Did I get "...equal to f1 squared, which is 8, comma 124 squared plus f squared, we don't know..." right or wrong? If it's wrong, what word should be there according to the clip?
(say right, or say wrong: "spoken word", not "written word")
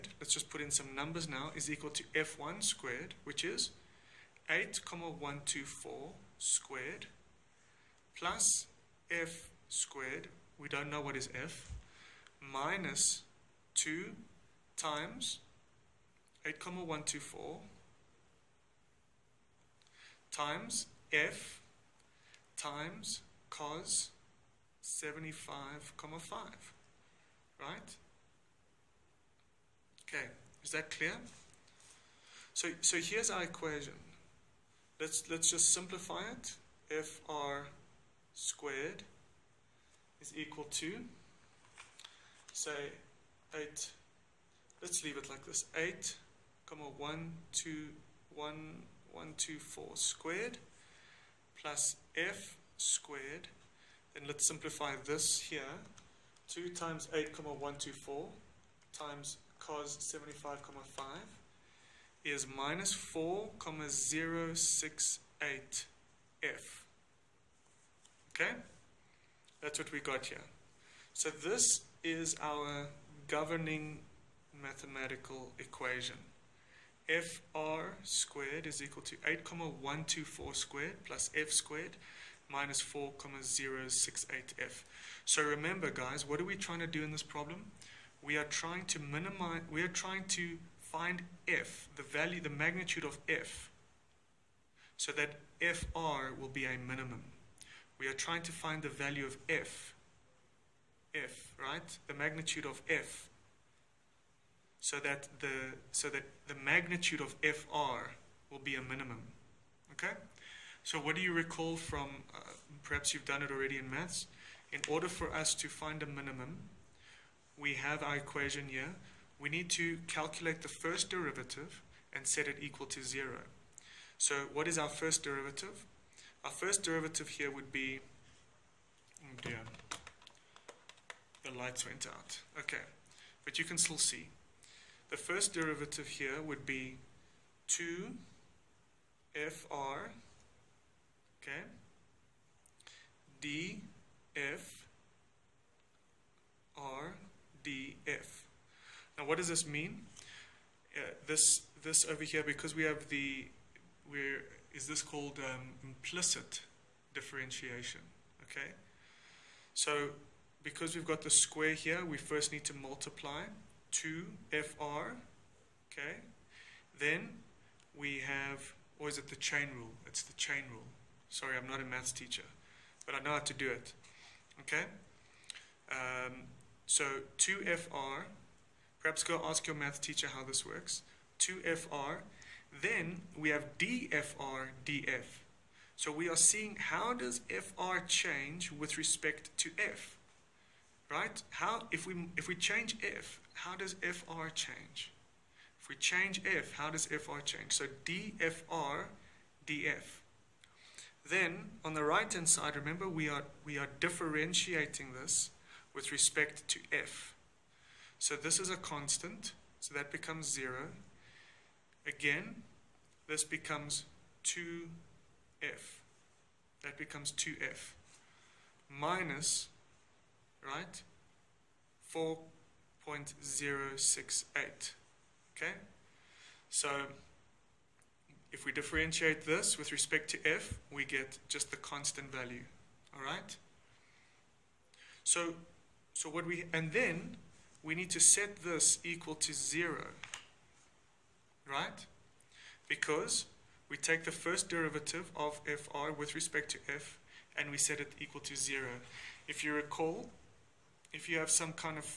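right.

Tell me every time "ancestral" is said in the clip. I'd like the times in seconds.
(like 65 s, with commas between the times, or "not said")
not said.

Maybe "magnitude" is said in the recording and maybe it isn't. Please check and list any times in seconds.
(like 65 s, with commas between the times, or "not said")
92 s, 102 s, 106 s.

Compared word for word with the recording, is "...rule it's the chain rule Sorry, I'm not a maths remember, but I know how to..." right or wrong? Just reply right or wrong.
wrong.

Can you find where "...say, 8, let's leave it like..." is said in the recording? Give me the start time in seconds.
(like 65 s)
42 s.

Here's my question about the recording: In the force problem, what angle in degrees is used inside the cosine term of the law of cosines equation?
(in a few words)
75.5.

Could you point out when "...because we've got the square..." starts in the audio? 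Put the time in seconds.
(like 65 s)
160 s.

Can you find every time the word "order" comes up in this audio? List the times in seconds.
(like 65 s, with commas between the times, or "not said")
114 s.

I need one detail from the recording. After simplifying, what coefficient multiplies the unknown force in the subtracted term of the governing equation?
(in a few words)
4.068.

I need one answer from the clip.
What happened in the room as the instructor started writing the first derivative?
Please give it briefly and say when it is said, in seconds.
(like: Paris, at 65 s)
The lights went out, at 131 s.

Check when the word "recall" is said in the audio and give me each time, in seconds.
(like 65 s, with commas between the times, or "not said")
111 s, 249 s.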